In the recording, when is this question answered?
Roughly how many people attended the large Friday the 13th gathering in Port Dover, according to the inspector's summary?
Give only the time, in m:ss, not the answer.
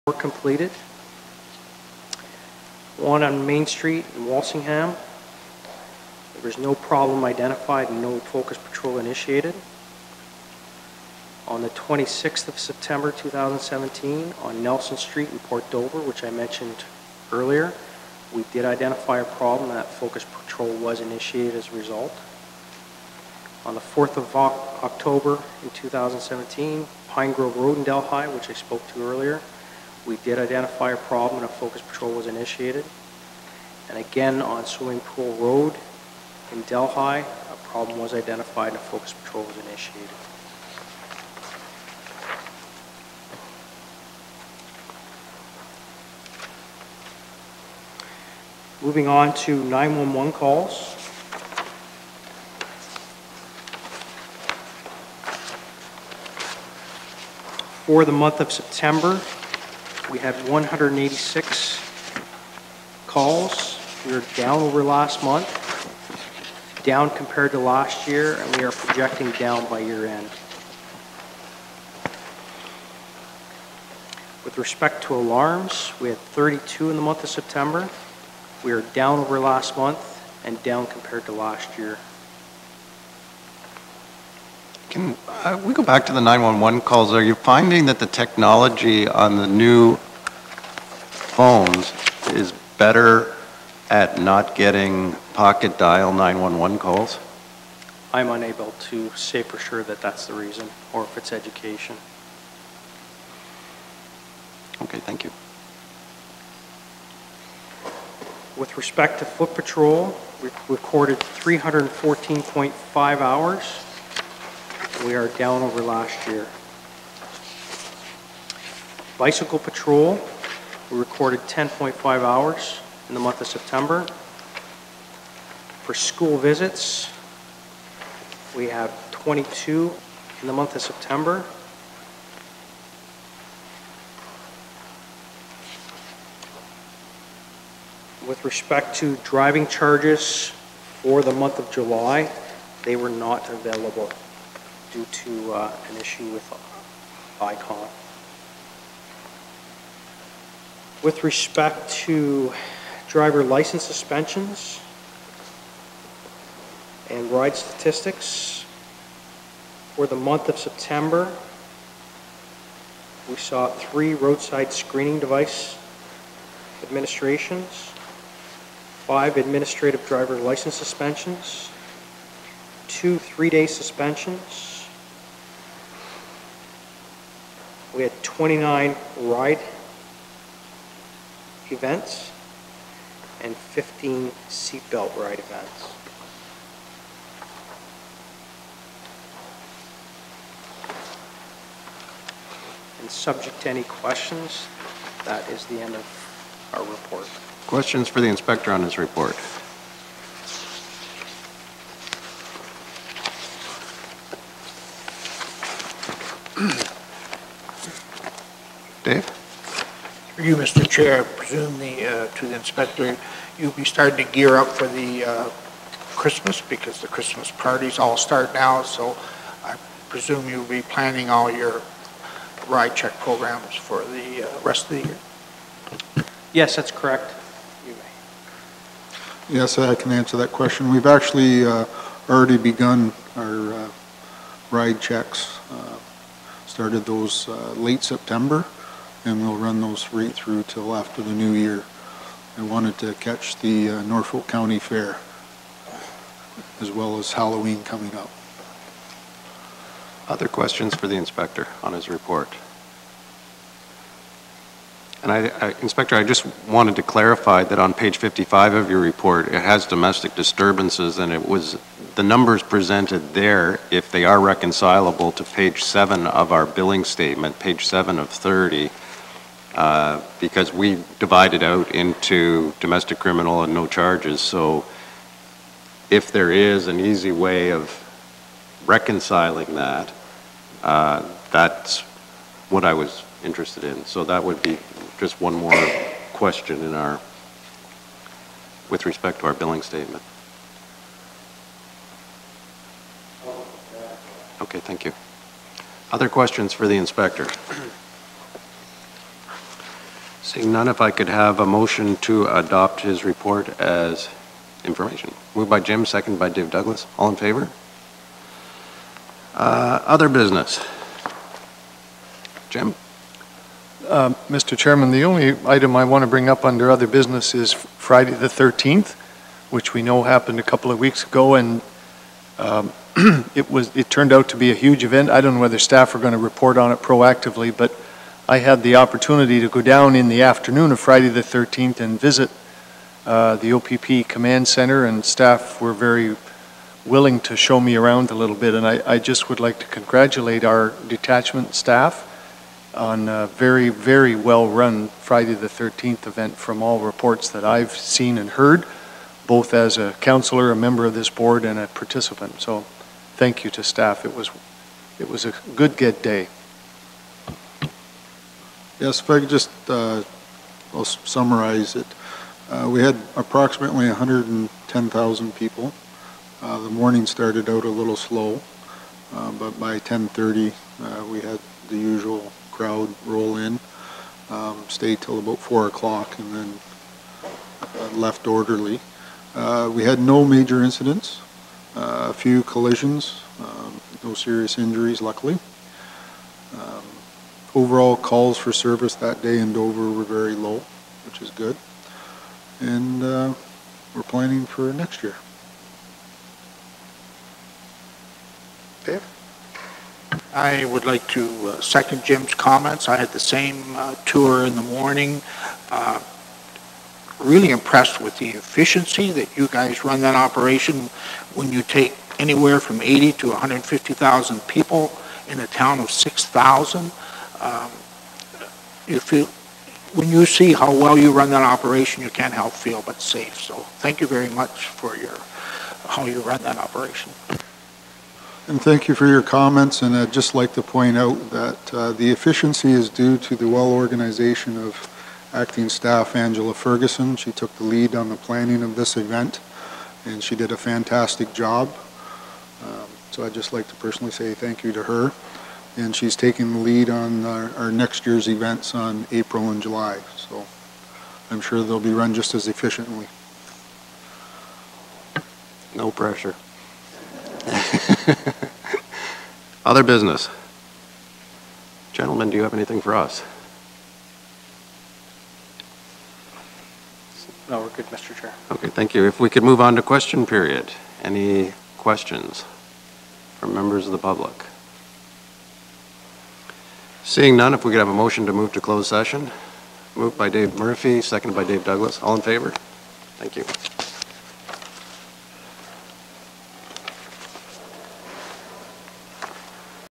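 6:04.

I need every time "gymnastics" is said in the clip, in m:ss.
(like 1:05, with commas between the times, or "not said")
not said.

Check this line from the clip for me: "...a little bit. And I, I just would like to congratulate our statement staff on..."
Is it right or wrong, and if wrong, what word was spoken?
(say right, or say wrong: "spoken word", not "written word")
wrong: "detachment", not "statement".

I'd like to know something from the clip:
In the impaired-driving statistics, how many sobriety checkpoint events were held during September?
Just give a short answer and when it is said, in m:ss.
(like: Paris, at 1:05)
29, at 2:58.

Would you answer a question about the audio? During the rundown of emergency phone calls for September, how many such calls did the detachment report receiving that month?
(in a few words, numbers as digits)
186.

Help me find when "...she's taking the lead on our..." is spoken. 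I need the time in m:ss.
7:26.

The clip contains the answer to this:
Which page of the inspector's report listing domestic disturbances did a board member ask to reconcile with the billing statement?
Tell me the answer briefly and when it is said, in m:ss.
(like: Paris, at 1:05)
55, at 4:17.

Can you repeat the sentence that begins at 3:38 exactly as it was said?
So I presume you'll be planning all your ride check programs for the uh, rest of the year.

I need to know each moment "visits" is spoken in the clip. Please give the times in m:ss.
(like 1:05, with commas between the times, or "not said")
2:06, 5:32.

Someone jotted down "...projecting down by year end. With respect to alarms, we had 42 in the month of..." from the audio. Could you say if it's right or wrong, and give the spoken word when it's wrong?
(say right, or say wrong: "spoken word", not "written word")
wrong: "32", not "42".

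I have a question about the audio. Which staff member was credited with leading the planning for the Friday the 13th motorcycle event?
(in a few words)
Angela Ferguson.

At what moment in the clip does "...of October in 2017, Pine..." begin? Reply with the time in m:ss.
0:24.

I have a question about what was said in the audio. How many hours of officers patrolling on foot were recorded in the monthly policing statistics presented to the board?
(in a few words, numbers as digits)
314.5.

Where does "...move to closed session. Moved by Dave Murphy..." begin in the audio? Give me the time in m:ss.
7:58.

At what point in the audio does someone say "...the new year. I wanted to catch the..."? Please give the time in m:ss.
4:01.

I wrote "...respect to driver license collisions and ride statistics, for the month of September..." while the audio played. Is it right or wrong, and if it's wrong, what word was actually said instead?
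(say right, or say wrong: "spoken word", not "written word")
wrong: "suspensions", not "collisions".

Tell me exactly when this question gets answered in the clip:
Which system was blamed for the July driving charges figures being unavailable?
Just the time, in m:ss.
2:27.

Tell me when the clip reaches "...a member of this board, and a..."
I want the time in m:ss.
5:50.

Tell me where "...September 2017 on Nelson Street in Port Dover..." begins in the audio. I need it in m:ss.
0:12.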